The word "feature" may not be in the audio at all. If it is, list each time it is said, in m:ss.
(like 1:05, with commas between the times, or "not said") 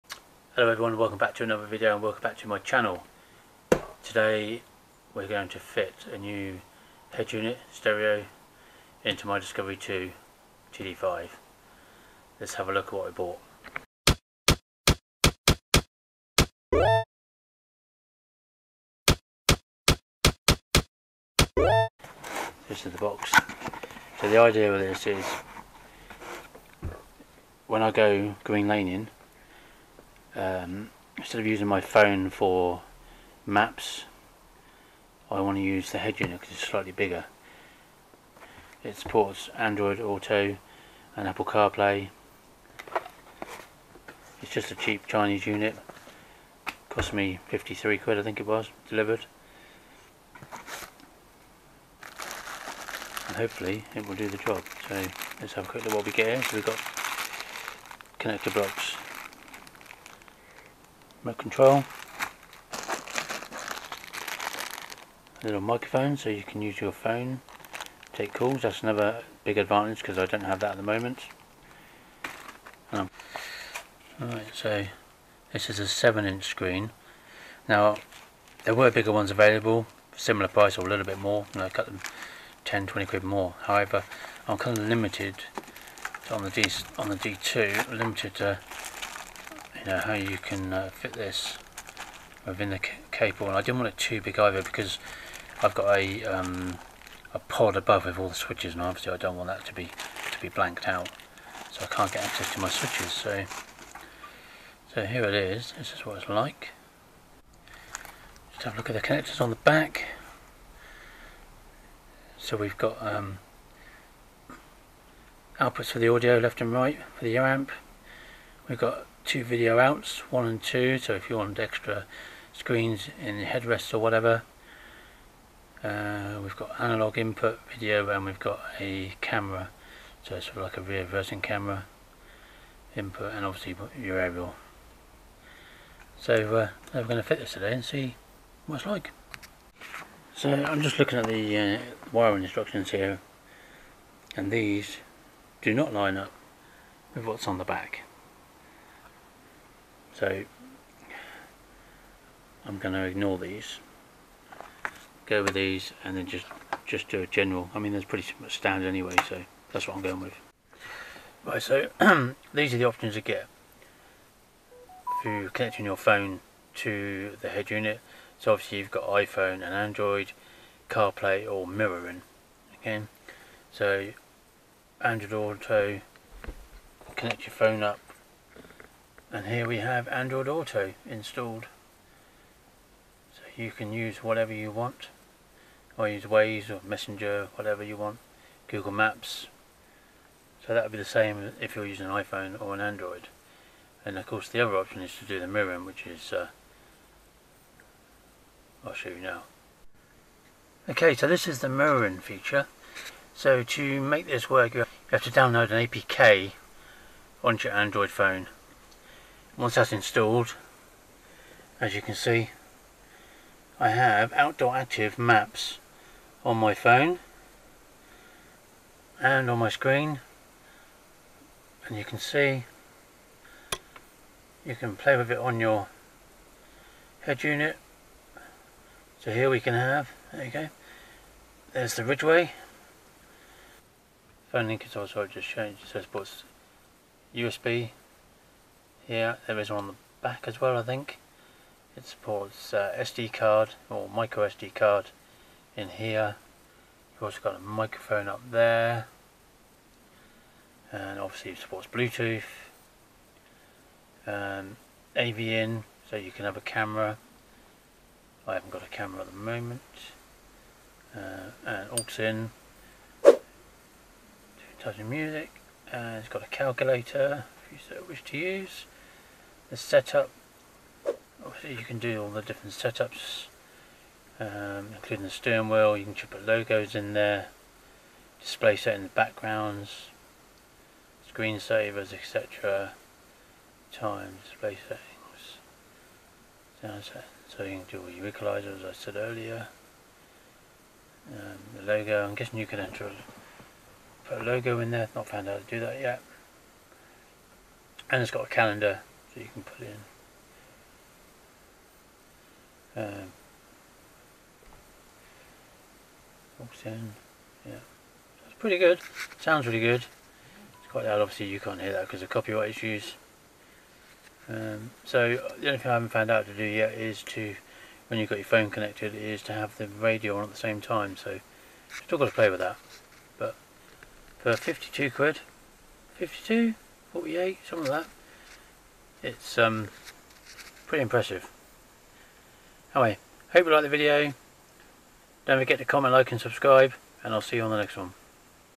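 3:22.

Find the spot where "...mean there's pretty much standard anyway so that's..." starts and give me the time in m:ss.
2:37.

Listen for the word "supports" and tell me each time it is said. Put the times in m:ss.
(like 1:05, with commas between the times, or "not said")
0:38, 4:02, 4:11.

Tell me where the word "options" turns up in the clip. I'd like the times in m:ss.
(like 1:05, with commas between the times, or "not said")
2:42, 3:14.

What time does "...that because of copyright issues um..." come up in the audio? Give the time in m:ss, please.
5:11.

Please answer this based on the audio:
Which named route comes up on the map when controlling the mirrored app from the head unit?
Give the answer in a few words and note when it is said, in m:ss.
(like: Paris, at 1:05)
The Ridgeway, at 3:51.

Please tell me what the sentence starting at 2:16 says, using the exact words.
So uh, we're going to fit this today and see what it's like.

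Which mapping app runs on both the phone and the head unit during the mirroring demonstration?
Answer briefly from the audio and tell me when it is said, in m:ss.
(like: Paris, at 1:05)
Outdoor Active, at 3:34.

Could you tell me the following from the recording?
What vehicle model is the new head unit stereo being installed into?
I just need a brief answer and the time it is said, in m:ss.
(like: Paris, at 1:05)
Discovery 2 TD5, at 0:09.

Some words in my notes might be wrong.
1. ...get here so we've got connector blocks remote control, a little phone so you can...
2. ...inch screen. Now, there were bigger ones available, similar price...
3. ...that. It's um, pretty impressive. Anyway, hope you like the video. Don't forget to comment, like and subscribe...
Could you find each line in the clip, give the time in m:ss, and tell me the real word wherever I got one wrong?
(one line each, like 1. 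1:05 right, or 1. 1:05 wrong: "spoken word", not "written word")
1. 0:56 wrong: "microphone", not "phone"
2. 1:16 right
3. 5:29 right.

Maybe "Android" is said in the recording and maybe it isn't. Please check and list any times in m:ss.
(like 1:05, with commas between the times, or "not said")
0:39, 2:49, 2:54, 3:00, 3:12, 3:27.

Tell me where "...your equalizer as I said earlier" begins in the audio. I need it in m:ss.
4:48.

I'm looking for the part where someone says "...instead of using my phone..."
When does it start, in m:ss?
0:31.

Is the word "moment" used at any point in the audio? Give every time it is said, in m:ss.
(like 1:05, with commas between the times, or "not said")
1:10, 4:19.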